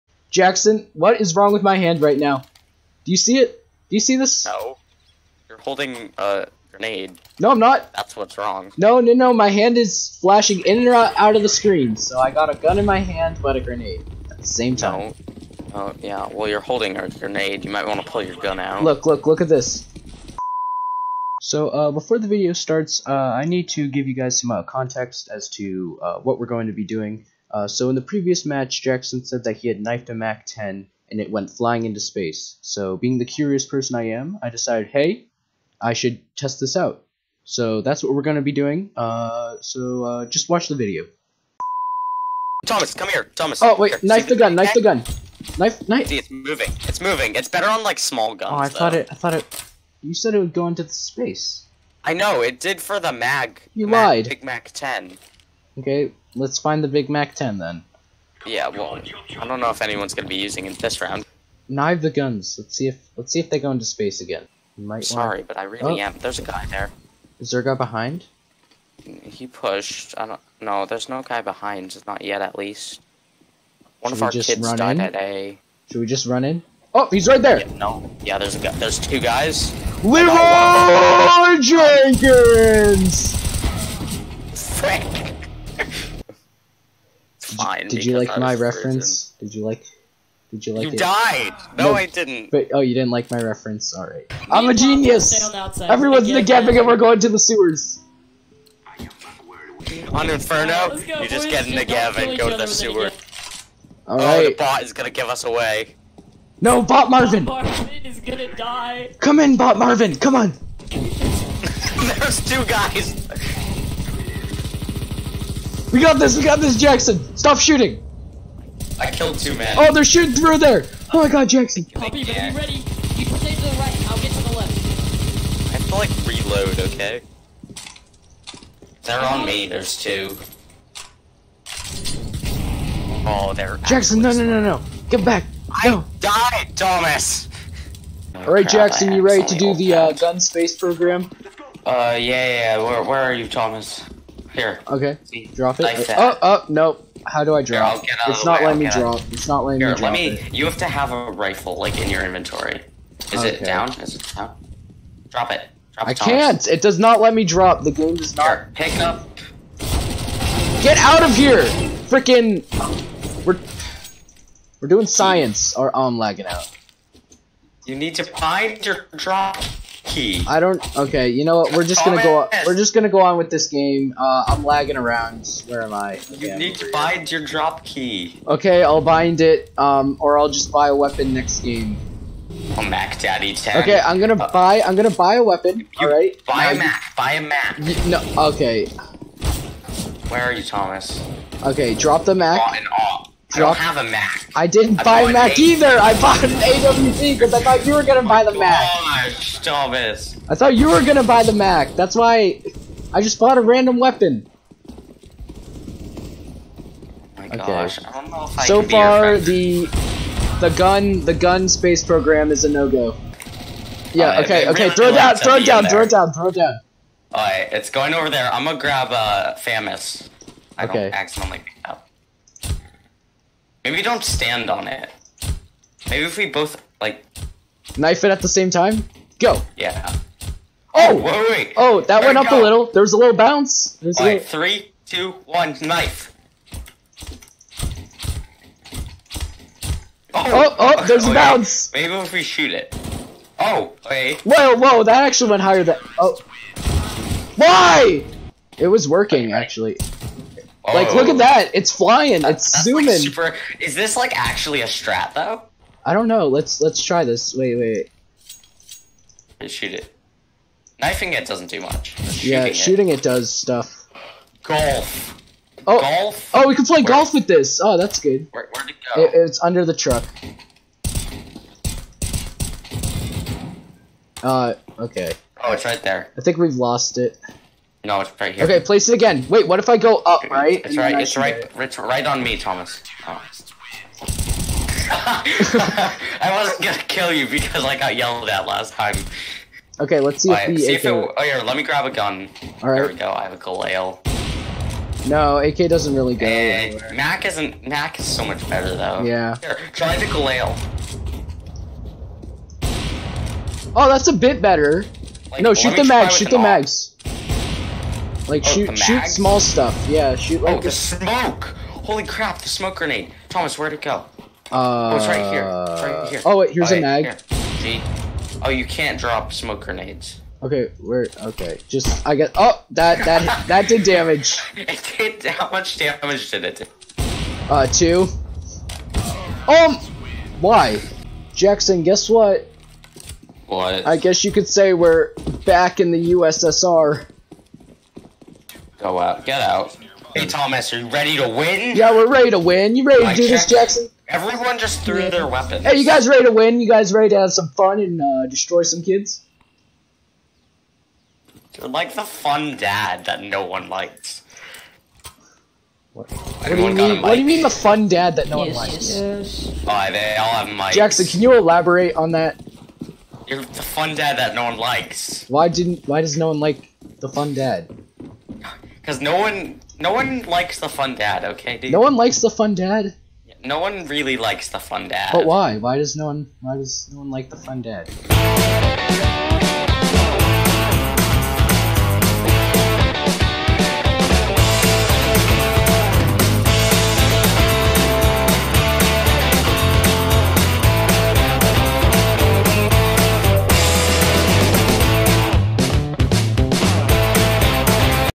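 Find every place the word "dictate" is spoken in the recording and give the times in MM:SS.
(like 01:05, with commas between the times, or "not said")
not said.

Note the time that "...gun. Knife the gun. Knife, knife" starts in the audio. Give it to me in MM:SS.
00:44.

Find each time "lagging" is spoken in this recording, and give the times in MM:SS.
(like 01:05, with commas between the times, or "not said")
02:46, 02:54.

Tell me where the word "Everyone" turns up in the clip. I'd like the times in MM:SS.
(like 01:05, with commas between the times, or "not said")
01:35, 05:44.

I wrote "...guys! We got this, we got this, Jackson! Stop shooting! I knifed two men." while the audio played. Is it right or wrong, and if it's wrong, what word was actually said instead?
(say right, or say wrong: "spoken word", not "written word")
wrong: "killed", not "knifed".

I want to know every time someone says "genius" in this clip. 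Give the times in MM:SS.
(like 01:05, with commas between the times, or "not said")
01:34.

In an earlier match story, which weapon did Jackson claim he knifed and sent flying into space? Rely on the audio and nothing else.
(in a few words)
MAC-10.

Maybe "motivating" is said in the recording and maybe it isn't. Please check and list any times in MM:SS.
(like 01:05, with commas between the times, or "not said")
not said.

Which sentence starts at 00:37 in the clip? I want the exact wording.
So that's what we're going to be doing.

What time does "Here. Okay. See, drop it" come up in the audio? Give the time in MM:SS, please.
02:24.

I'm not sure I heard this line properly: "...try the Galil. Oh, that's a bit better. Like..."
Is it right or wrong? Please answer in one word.
right.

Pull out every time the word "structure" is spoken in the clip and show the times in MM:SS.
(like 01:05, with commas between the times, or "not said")
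not said.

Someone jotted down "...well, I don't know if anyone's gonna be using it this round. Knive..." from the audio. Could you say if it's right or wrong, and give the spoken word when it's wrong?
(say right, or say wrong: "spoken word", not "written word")
right.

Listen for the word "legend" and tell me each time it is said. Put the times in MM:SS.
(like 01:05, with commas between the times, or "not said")
not said.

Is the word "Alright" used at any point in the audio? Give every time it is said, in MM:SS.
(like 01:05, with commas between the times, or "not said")
01:44, 02:18, 03:37.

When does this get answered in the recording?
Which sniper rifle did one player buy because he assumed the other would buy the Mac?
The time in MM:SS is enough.
03:16.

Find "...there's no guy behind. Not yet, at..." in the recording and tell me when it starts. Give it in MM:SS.
01:10.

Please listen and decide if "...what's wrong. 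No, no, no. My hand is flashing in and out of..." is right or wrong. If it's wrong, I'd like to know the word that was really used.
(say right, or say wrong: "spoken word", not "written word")
right.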